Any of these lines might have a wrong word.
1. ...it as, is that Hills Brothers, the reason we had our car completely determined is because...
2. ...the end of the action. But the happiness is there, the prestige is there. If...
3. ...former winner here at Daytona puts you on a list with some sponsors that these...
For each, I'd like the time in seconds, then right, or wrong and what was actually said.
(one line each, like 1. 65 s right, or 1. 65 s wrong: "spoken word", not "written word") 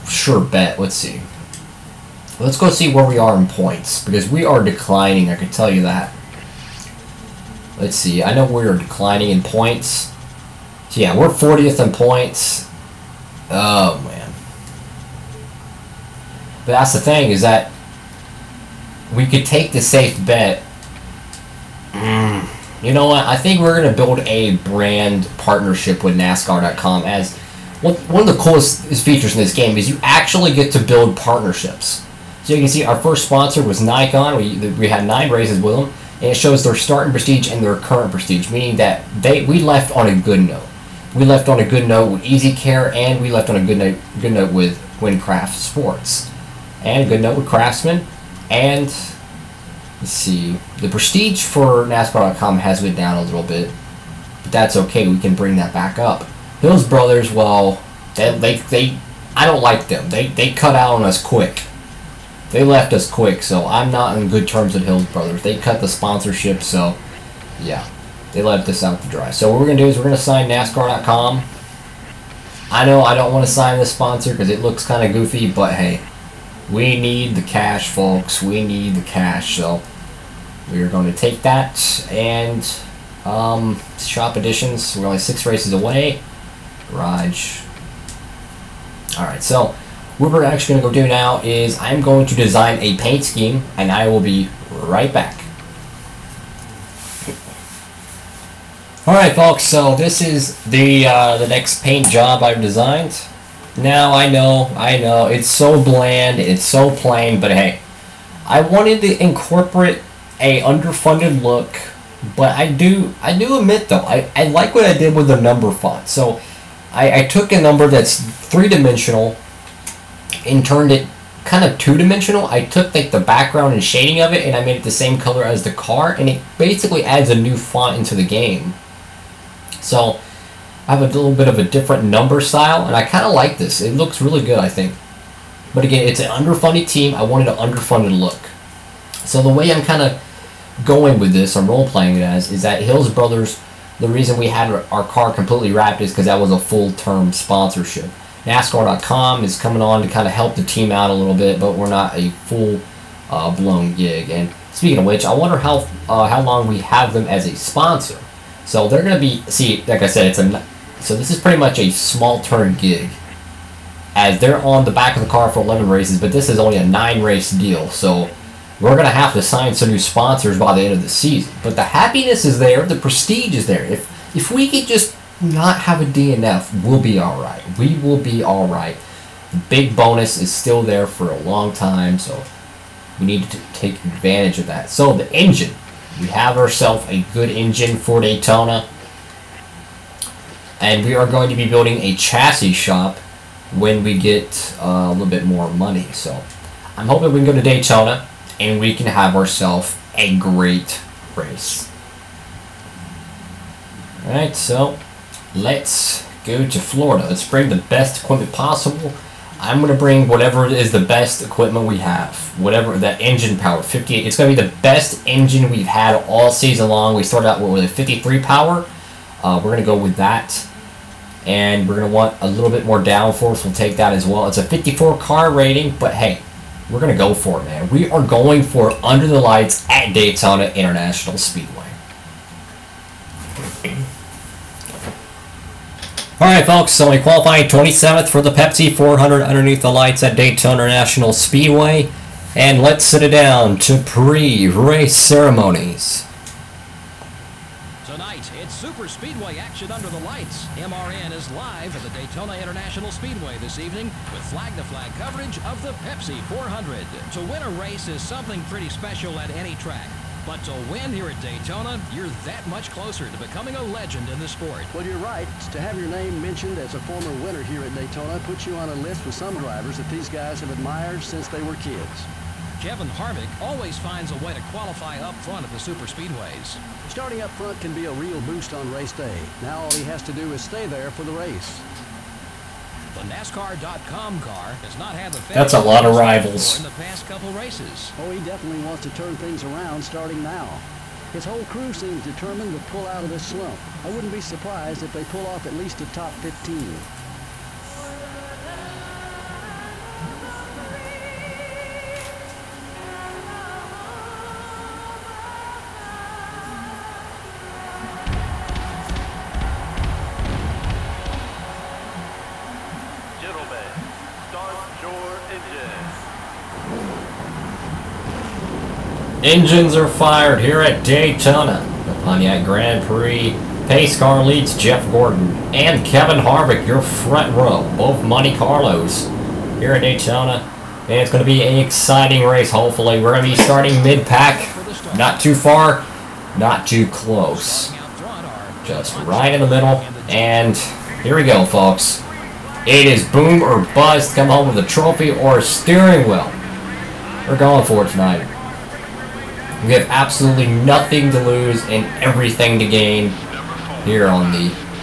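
1. 142 s wrong: "wrapped", not "determined"
2. 170 s wrong: "season", not "action"
3. 266 s wrong: "drivers", not "sponsors".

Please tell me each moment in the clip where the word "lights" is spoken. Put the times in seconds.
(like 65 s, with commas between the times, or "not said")
229 s, 239 s, 250 s.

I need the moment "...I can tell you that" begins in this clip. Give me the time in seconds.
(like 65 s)
5 s.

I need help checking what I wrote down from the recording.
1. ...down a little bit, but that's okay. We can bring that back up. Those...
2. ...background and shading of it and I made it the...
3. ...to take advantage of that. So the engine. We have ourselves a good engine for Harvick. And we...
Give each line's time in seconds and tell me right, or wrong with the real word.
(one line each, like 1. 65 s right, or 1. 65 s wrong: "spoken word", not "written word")
1. 52 s right
2. 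123 s right
3. 183 s wrong: "Daytona", not "Harvick".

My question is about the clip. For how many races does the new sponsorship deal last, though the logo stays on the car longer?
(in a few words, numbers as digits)
9.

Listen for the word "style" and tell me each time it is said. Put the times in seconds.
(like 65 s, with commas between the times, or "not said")
132 s.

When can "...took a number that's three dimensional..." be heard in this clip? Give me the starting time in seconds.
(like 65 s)
117 s.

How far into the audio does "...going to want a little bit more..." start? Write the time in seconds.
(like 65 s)
221 s.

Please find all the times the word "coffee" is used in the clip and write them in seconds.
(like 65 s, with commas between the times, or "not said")
not said.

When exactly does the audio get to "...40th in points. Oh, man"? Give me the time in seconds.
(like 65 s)
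11 s.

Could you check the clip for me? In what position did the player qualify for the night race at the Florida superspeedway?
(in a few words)
27th.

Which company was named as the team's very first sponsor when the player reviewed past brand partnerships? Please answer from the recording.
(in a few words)
Nikon.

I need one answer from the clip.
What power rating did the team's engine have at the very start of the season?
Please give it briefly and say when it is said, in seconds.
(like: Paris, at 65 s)
53, at 217 s.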